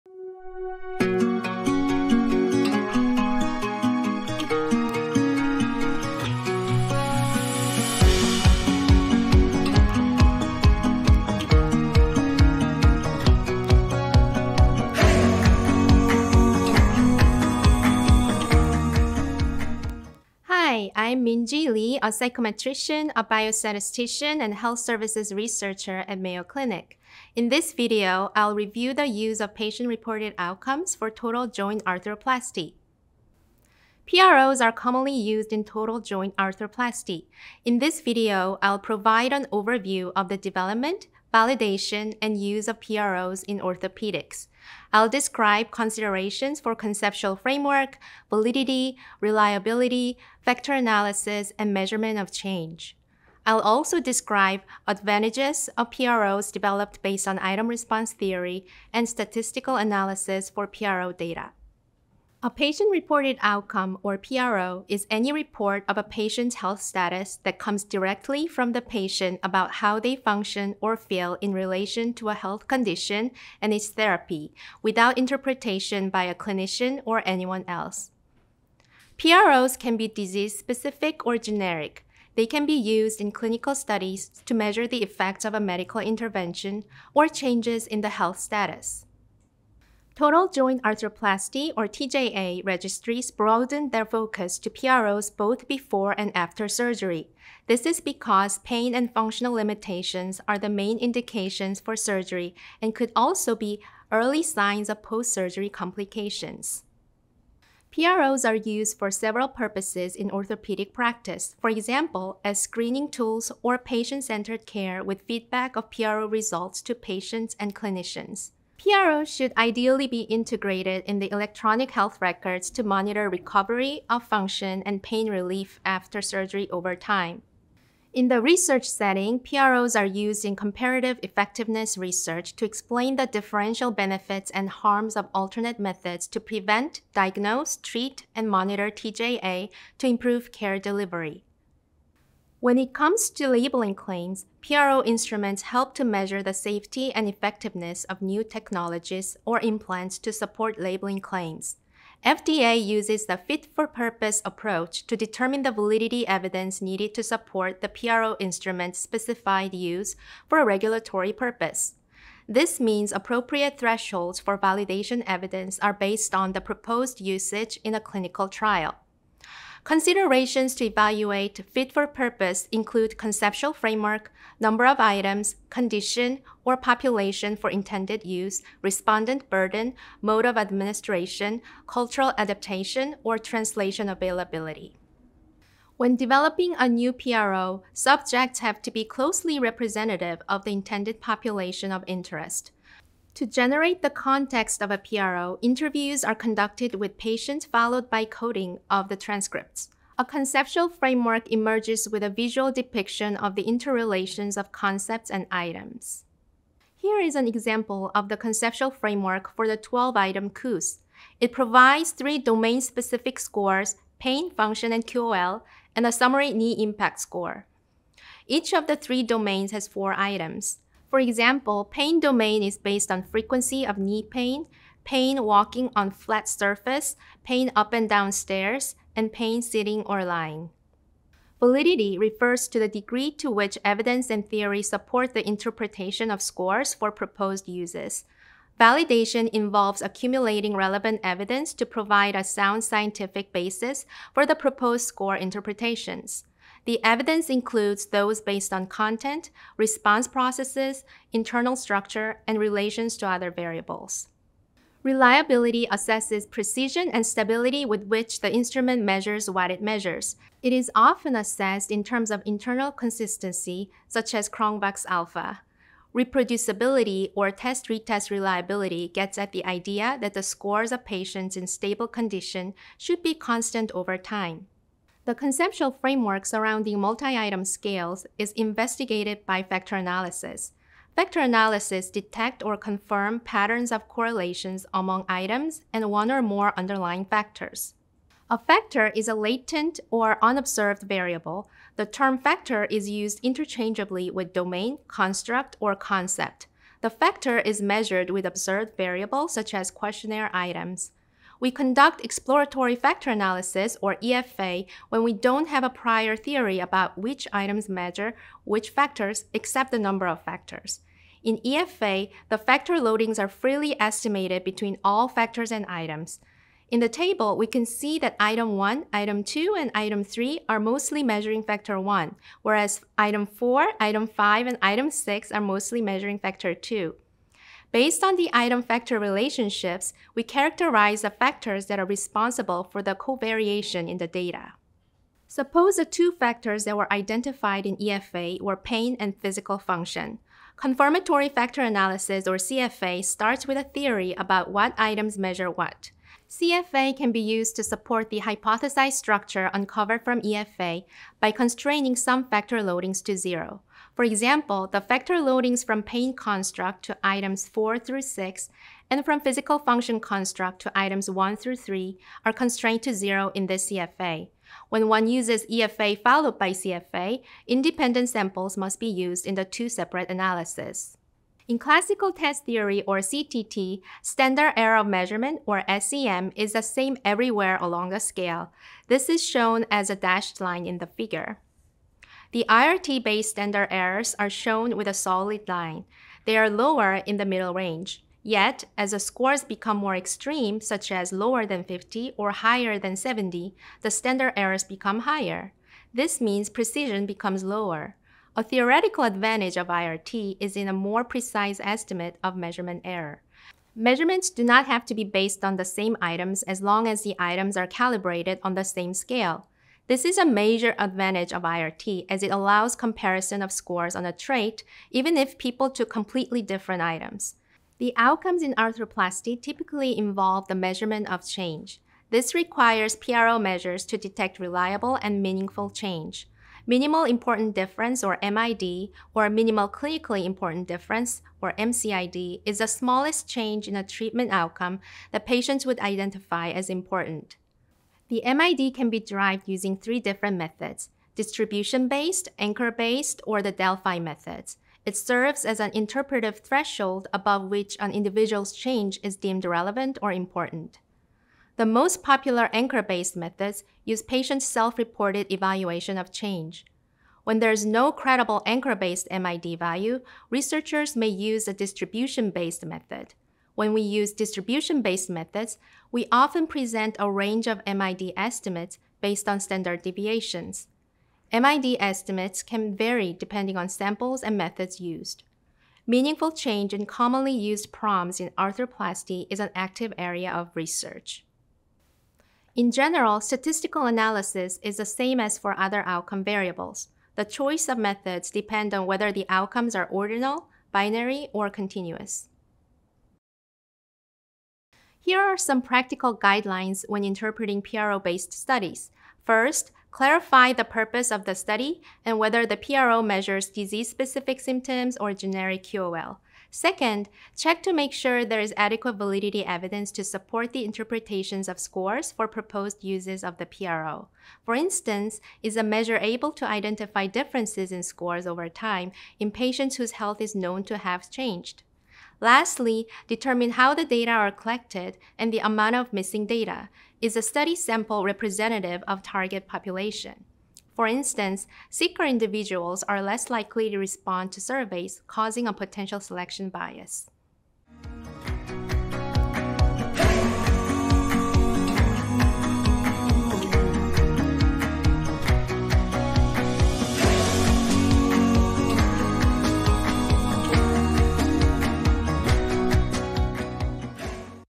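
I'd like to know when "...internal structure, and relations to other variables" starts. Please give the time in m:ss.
4:11.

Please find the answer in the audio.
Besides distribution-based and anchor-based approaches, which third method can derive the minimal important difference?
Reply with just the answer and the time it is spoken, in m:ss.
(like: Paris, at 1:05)
Delphi method, at 7:23.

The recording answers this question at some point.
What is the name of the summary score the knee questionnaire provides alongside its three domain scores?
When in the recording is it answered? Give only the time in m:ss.
3:36.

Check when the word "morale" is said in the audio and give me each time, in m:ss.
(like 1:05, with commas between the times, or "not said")
not said.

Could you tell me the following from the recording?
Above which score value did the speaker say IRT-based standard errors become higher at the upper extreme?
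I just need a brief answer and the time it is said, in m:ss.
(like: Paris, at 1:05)
70, at 6:33.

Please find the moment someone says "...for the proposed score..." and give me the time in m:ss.
4:04.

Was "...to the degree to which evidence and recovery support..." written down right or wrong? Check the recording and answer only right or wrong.
wrong.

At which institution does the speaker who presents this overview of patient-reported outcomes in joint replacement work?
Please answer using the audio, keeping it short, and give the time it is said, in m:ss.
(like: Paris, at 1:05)
Mayo Clinic, at 0:26.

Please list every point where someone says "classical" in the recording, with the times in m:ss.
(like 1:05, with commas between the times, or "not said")
6:11.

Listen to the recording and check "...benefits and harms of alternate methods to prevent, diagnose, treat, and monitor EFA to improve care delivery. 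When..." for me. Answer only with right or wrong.
wrong.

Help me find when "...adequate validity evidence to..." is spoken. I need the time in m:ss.
8:28.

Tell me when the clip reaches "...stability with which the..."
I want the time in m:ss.
4:17.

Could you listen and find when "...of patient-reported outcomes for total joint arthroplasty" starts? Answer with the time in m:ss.
0:29.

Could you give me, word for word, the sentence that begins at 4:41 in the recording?
Factor analysis detect or confirm patterns of correlations among items and one or more underlying factors.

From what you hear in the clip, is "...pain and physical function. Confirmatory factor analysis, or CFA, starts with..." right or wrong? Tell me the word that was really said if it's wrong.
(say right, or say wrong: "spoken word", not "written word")
right.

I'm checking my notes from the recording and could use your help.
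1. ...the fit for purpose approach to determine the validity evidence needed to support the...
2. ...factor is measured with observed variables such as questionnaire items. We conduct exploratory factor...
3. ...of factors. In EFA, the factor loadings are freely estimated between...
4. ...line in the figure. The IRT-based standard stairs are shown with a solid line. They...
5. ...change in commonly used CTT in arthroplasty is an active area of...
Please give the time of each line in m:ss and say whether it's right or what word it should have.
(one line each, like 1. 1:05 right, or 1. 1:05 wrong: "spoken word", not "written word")
1. 2:33 right
2. 4:57 right
3. 5:10 right
4. 6:20 wrong: "errors", not "stairs"
5. 7:56 wrong: "PROMs", not "CTT".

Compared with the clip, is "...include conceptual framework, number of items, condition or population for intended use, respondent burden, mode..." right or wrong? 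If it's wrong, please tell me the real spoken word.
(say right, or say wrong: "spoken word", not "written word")
right.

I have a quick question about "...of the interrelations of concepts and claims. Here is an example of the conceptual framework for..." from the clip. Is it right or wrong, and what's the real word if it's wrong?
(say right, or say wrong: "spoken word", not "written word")
wrong: "items", not "claims".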